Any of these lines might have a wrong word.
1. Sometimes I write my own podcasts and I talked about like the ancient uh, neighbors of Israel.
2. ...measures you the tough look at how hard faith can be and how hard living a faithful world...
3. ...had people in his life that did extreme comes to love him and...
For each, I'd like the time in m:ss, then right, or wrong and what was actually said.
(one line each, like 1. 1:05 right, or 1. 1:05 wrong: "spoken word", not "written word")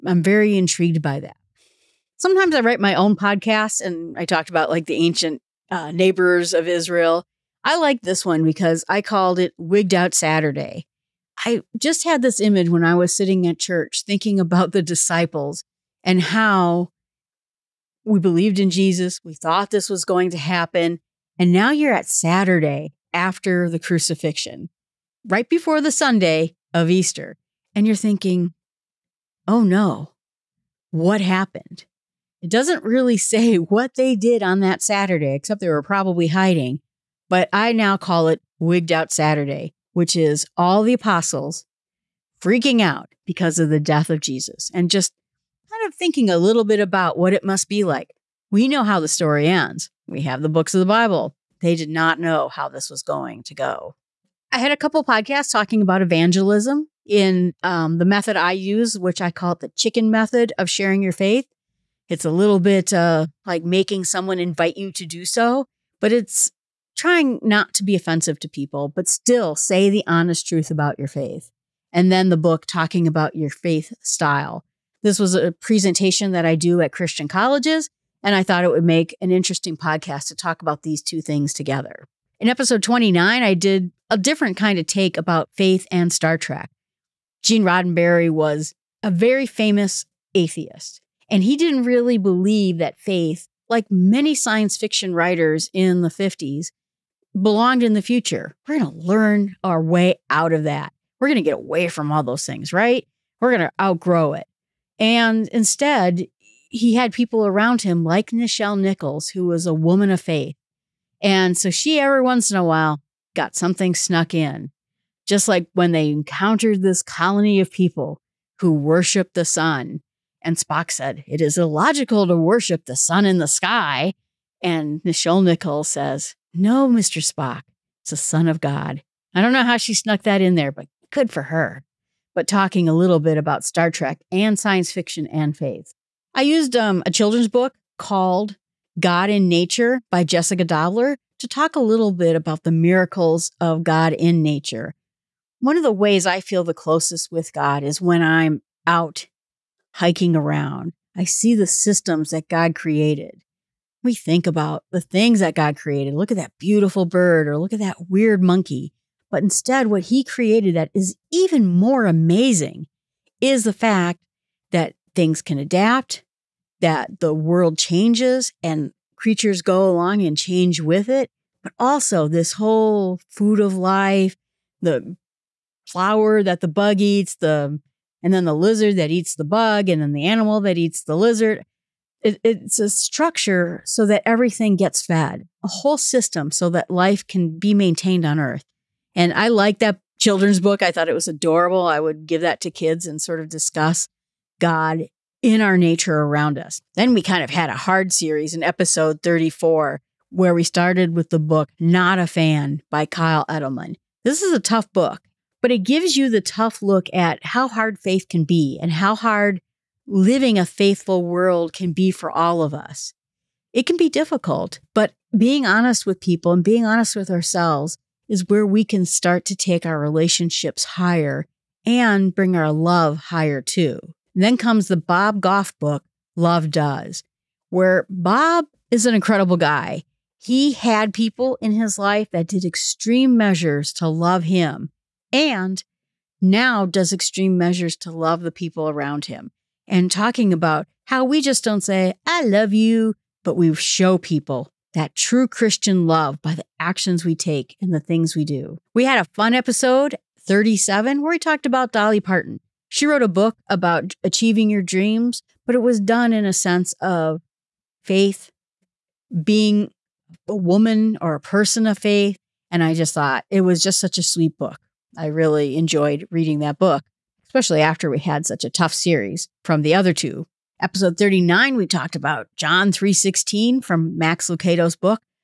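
1. 0:02 right
2. 3:25 wrong: "gives", not "measures"
3. 3:50 wrong: "measures", not "comes".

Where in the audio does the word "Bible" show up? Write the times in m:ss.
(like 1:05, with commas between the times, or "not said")
0:50.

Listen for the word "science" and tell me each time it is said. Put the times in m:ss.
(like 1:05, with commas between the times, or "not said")
1:34, 2:14.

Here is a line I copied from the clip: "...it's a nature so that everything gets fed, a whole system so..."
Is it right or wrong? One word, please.
wrong.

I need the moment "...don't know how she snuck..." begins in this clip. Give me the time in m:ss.
2:09.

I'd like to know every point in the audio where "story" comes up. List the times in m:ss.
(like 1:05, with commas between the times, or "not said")
0:49.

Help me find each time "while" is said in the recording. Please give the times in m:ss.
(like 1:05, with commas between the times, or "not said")
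1:52.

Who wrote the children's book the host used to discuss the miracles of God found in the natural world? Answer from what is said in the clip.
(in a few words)
Jessica Dobler.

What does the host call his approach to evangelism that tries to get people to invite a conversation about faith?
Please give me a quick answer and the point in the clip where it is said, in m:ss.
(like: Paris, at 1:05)
the chicken method, at 0:59.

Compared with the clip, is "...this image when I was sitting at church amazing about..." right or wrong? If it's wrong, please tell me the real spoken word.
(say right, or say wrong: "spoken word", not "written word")
wrong: "thinking", not "amazing".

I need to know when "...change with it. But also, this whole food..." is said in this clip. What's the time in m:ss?
2:50.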